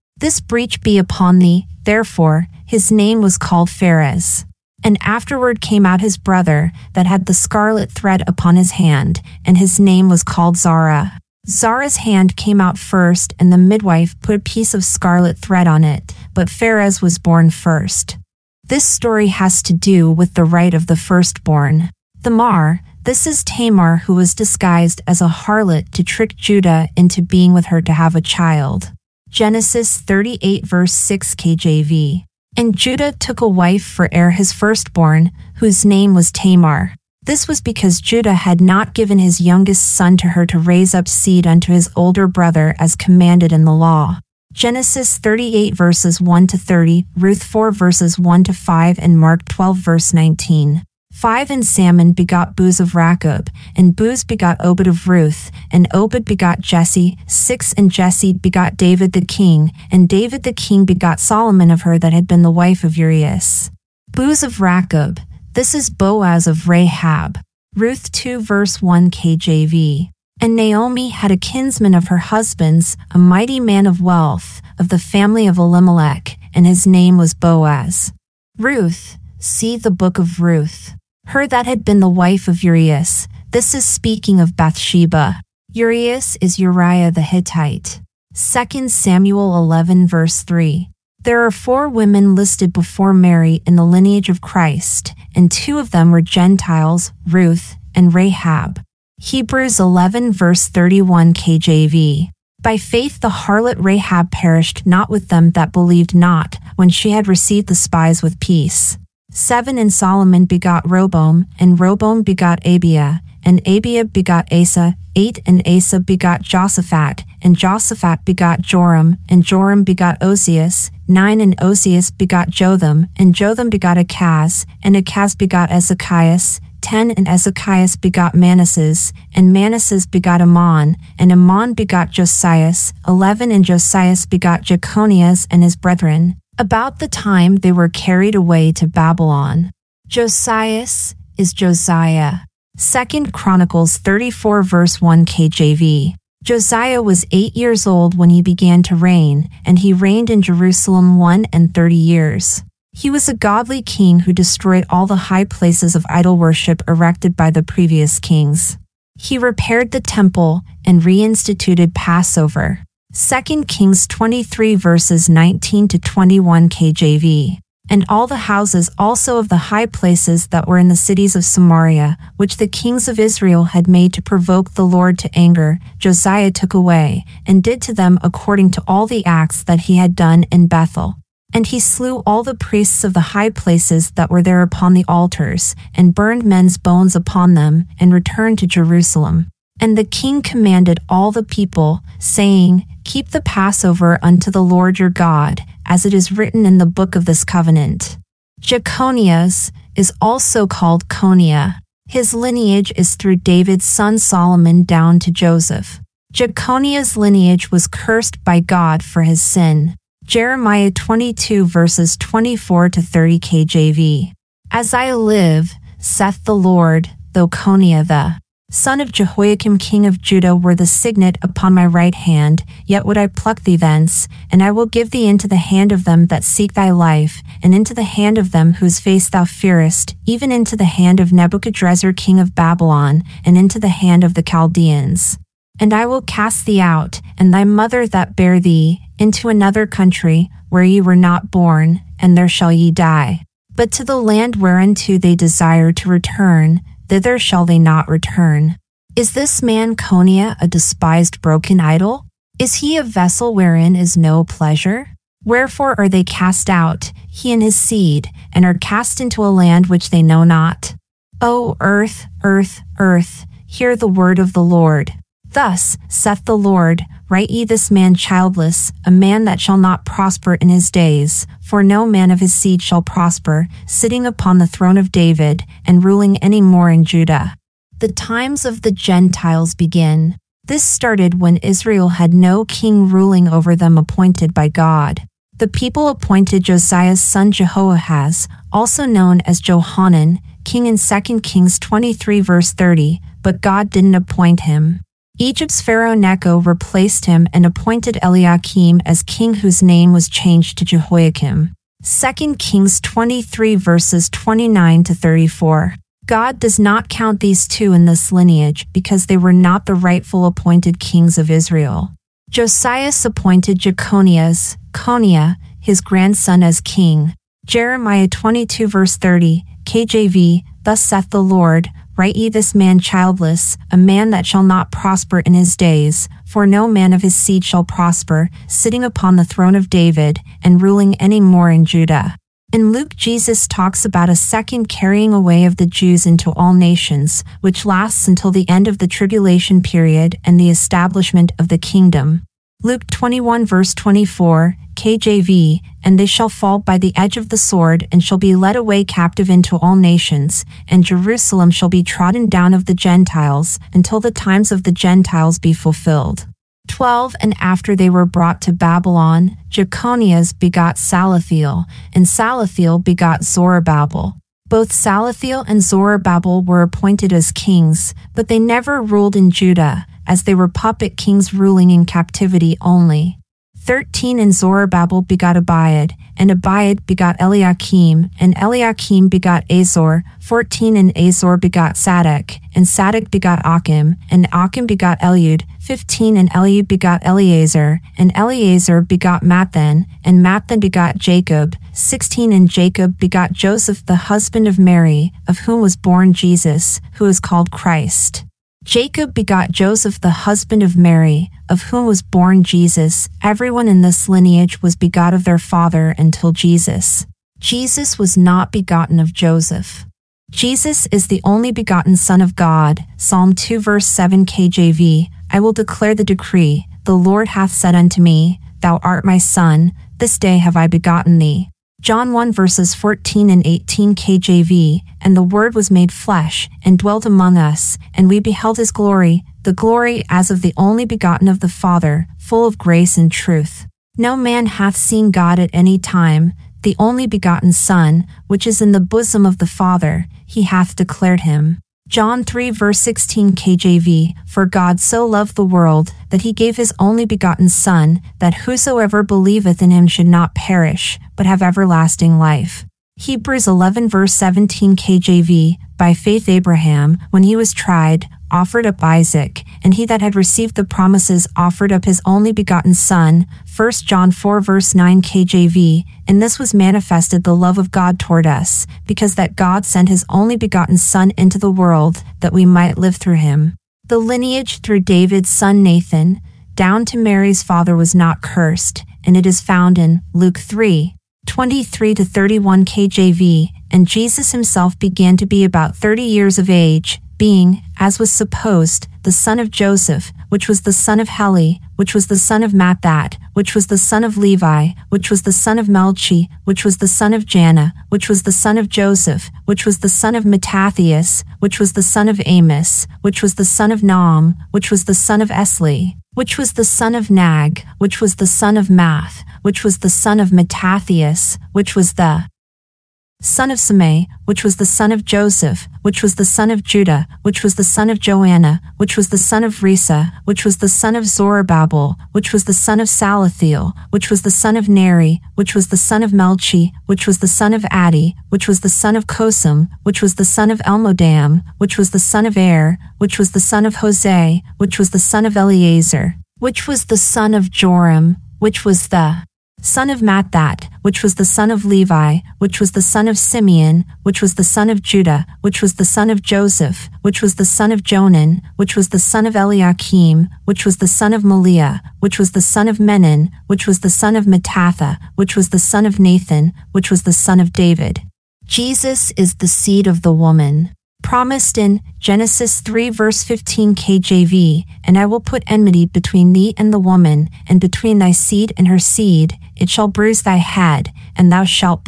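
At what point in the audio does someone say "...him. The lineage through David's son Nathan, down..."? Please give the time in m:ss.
7:53.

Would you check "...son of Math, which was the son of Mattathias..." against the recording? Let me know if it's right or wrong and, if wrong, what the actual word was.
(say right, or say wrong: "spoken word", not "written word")
right.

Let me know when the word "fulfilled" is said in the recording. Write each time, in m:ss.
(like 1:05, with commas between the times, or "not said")
5:55.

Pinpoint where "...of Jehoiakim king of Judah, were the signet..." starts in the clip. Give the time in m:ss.
3:38.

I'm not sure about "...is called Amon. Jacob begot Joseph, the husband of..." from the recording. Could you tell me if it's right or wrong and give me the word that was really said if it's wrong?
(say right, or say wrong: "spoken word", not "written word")
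wrong: "Christ", not "Amon".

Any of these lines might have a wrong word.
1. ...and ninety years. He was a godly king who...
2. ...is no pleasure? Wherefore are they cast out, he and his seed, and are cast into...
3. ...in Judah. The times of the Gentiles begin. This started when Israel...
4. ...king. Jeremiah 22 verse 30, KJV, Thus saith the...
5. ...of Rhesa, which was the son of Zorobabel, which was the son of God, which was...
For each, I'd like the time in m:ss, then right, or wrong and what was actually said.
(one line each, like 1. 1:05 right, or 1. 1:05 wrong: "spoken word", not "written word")
1. 2:31 wrong: "thirty", not "ninety"
2. 4:13 right
3. 4:36 right
4. 5:16 right
5. 8:39 wrong: "Salathiel", not "God".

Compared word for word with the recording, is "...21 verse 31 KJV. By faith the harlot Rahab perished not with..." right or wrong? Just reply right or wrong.
wrong.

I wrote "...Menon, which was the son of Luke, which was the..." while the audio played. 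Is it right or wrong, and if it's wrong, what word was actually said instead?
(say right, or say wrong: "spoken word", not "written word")
wrong: "Mattatha", not "Luke".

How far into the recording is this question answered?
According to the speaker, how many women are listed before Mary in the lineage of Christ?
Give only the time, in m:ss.
1:31.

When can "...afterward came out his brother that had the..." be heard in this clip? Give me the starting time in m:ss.
0:05.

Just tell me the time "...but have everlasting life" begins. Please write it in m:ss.
7:31.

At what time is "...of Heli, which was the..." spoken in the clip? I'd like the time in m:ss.
8:11.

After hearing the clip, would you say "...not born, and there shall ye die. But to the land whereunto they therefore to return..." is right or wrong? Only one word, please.
wrong.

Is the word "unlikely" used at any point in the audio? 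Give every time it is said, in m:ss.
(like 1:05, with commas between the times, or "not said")
not said.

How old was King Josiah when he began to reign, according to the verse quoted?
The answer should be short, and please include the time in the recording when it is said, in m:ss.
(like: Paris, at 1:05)
8, at 2:27.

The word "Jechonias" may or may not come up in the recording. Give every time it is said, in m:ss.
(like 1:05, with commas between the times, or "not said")
5:59.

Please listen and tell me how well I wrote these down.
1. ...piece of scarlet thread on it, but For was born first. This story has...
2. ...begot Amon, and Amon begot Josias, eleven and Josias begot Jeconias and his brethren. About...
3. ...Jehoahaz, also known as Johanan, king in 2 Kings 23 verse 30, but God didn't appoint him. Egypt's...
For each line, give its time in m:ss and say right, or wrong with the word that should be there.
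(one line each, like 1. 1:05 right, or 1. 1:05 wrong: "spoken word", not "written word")
1. 0:14 wrong: "Pharez", not "For"
2. 2:10 right
3. 4:47 right.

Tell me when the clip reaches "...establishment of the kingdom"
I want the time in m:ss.
5:40.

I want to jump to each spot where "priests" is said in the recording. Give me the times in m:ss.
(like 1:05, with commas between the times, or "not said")
3:02.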